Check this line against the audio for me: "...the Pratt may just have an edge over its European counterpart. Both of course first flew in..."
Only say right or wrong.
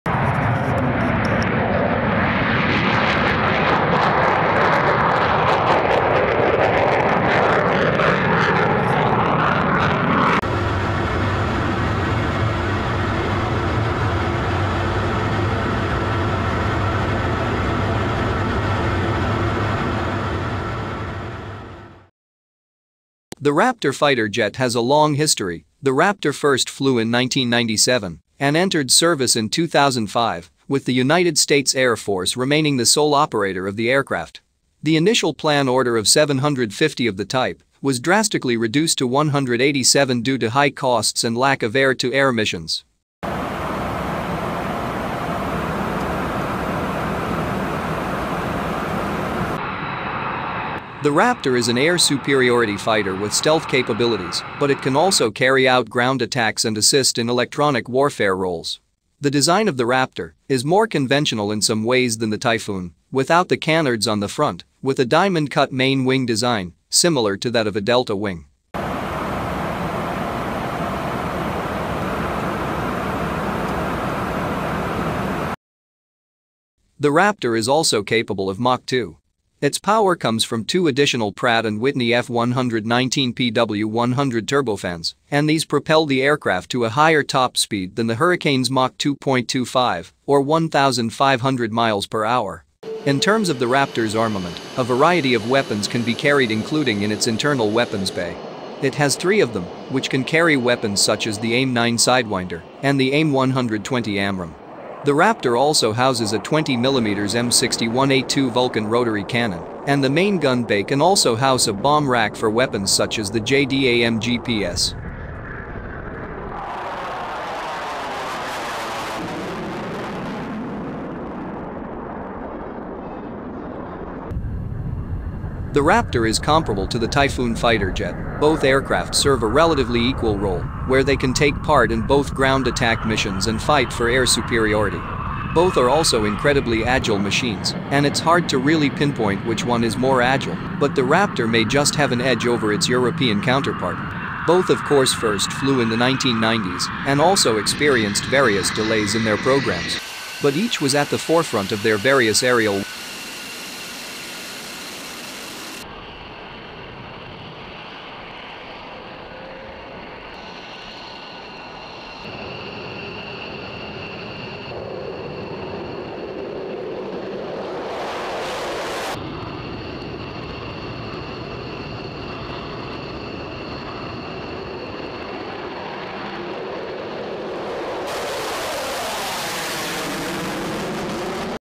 wrong.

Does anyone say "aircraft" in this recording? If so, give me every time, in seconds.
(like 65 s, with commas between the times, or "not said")
33 s, 86 s, 128 s.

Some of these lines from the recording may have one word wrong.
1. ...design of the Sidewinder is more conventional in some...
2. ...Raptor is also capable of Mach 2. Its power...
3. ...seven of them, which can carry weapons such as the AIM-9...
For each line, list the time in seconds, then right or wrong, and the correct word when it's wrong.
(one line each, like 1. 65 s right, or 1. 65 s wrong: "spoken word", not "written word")
1. 59 s wrong: "Raptor", not "Sidewinder"
2. 77 s right
3. 99 s wrong: "three", not "seven".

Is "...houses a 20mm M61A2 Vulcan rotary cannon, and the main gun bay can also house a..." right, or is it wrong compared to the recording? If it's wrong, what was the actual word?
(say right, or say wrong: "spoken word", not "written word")
right.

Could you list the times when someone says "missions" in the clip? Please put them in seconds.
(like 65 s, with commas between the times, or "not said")
42 s, 133 s.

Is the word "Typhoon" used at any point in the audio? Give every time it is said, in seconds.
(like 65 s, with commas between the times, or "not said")
62 s, 127 s.